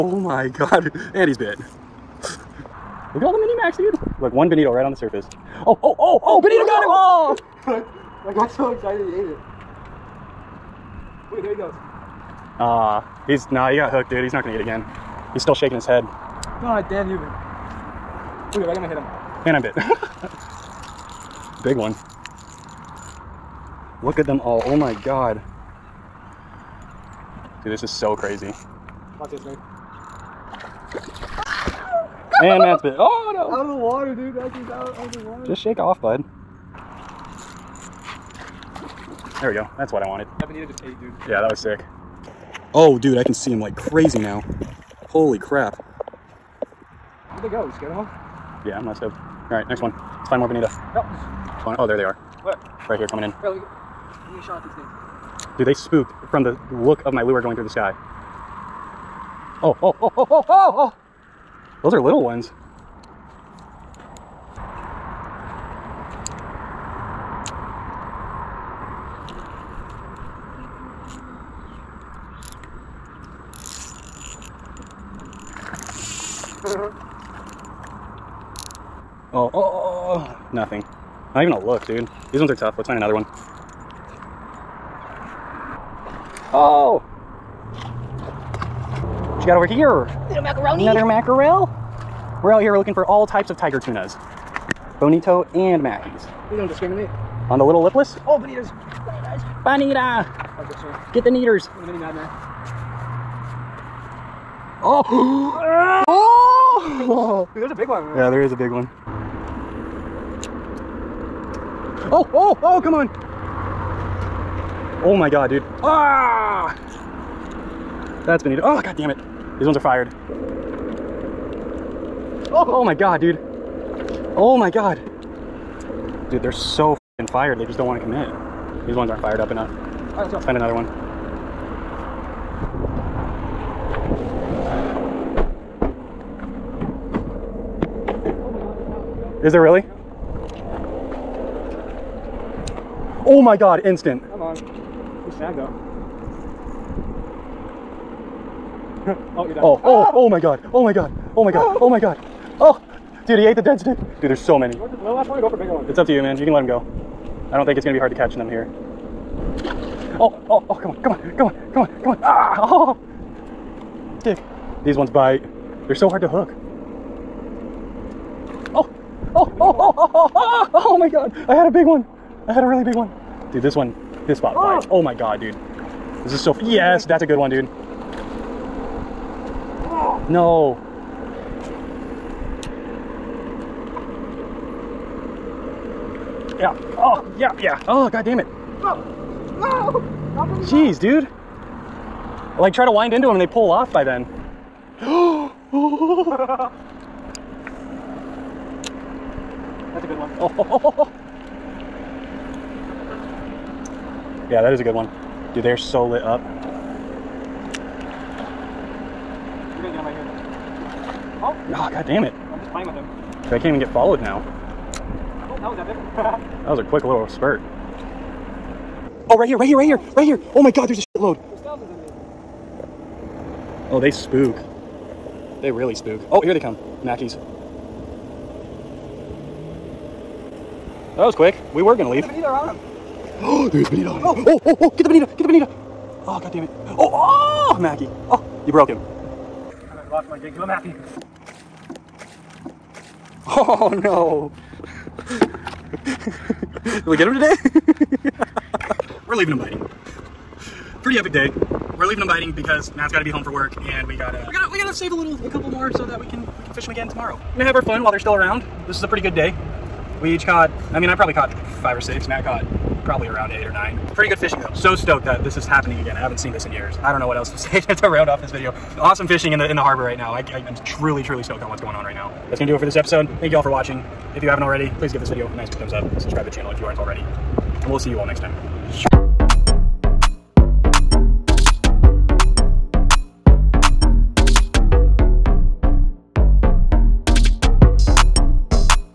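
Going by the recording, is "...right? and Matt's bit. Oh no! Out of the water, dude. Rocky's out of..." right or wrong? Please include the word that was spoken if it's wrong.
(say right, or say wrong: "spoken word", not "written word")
right.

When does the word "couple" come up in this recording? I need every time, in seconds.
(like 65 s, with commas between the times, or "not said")
255 s.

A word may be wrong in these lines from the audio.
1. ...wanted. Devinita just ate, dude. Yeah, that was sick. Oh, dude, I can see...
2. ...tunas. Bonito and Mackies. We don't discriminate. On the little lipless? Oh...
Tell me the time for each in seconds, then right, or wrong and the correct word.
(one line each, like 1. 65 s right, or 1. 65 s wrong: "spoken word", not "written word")
1. 40 s right
2. 93 s right.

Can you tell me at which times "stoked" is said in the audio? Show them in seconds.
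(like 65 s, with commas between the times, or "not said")
48 s, 264 s, 271 s.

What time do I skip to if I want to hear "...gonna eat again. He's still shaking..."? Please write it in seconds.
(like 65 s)
14 s.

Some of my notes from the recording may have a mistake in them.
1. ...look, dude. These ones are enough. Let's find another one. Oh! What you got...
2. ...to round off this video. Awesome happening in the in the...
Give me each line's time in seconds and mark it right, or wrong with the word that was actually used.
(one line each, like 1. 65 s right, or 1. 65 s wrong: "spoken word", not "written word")
1. 81 s wrong: "tough", not "enough"
2. 267 s wrong: "fishing", not "happening".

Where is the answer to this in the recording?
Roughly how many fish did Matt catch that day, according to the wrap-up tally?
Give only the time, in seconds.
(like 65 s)
263 s.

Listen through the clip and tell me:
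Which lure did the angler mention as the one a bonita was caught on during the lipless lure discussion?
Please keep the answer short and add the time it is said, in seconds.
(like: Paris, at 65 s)
Mini Madman, at 101 s.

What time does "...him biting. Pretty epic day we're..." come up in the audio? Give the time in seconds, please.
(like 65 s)
249 s.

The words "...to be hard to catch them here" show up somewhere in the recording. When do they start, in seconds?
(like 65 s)
157 s.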